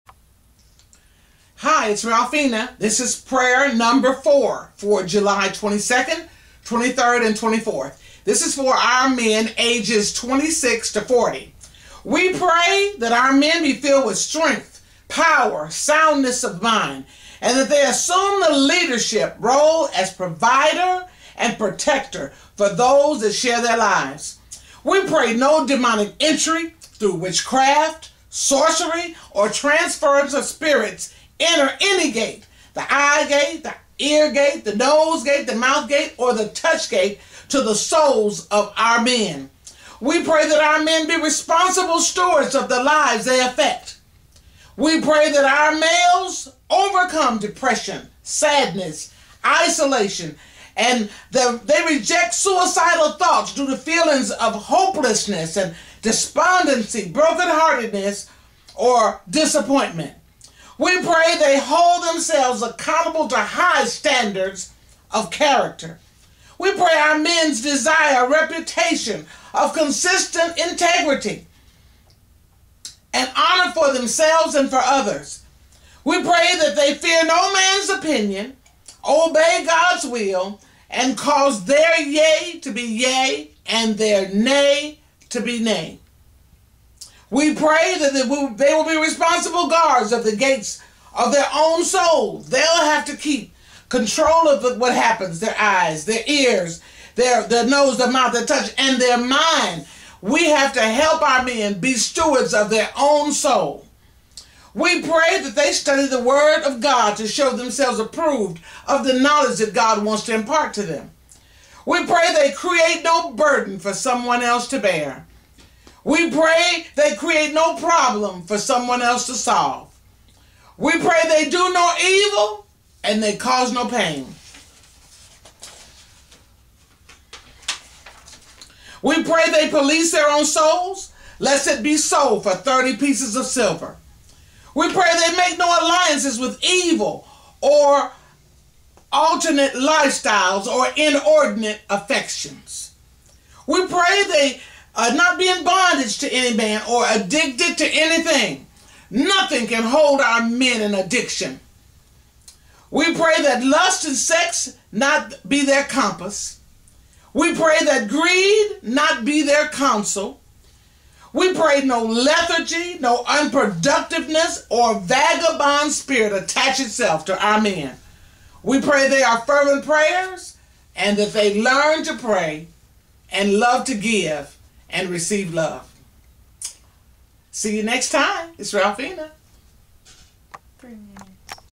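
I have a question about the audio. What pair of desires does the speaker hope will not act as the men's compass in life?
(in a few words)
lust and sex.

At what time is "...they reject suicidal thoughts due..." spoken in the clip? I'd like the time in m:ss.
0:51.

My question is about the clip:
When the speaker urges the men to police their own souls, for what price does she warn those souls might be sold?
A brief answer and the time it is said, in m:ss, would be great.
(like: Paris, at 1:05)
30 pieces of silver, at 2:12.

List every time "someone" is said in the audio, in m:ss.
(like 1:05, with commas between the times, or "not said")
1:53, 1:58.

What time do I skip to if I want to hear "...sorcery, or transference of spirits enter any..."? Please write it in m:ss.
0:28.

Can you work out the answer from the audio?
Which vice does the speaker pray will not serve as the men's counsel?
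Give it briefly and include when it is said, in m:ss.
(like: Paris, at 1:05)
greed, at 2:38.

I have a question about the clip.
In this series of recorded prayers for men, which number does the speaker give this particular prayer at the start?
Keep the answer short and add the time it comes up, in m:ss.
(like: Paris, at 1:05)
4, at 0:04.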